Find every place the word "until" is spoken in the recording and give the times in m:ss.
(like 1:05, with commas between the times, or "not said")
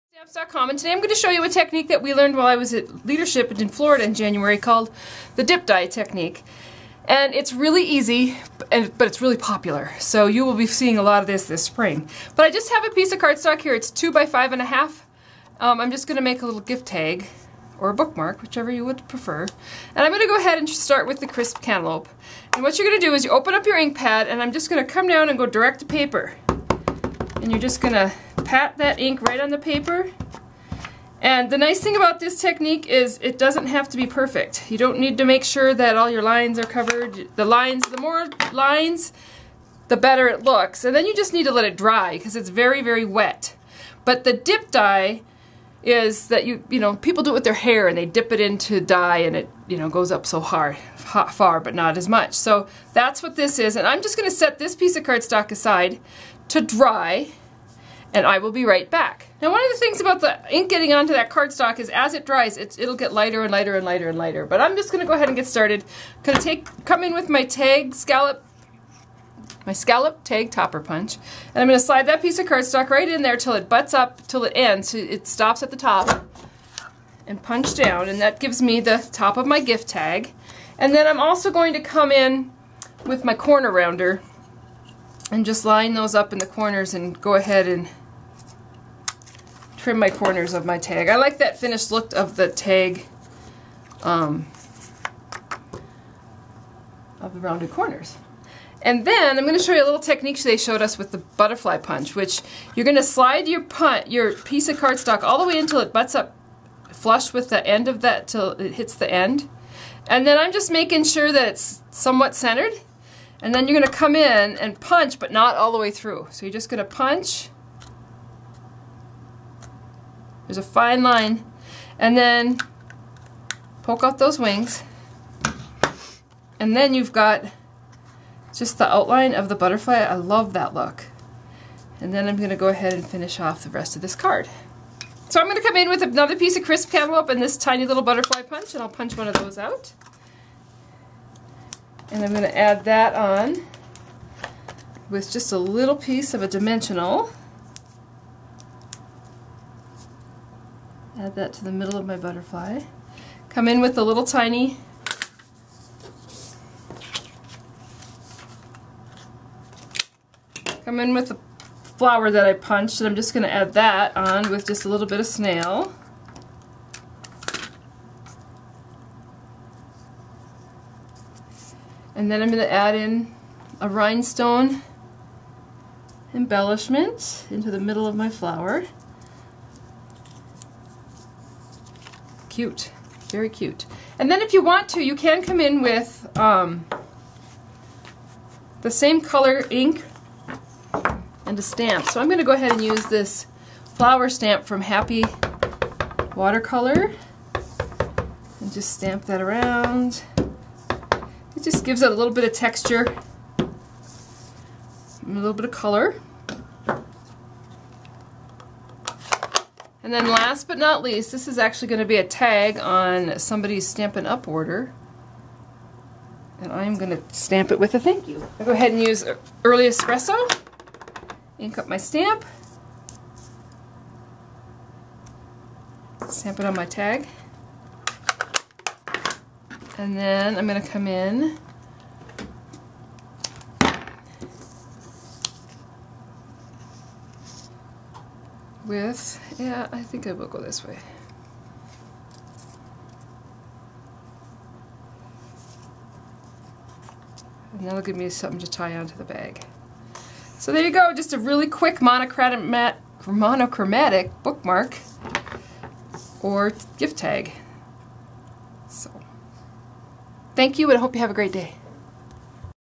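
1:45.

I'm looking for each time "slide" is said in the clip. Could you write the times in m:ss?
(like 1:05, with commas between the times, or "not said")
1:11, 1:43.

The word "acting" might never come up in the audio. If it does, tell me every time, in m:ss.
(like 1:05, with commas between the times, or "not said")
not said.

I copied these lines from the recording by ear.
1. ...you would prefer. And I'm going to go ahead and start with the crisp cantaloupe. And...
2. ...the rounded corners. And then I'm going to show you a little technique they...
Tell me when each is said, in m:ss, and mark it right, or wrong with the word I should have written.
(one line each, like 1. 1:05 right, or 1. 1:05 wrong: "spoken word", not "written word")
1. 0:18 right
2. 1:37 right.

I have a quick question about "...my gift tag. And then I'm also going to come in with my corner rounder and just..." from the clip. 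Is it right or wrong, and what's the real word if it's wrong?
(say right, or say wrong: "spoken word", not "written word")
right.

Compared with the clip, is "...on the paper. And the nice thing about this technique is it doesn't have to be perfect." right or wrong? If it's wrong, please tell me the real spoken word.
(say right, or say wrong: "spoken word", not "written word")
right.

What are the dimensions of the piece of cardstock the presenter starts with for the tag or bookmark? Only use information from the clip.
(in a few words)
2 by 5 1/2.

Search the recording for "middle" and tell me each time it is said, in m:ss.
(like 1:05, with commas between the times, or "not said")
2:31, 2:57.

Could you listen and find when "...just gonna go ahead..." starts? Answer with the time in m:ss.
1:04.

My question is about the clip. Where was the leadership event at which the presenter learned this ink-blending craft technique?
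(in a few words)
Florida.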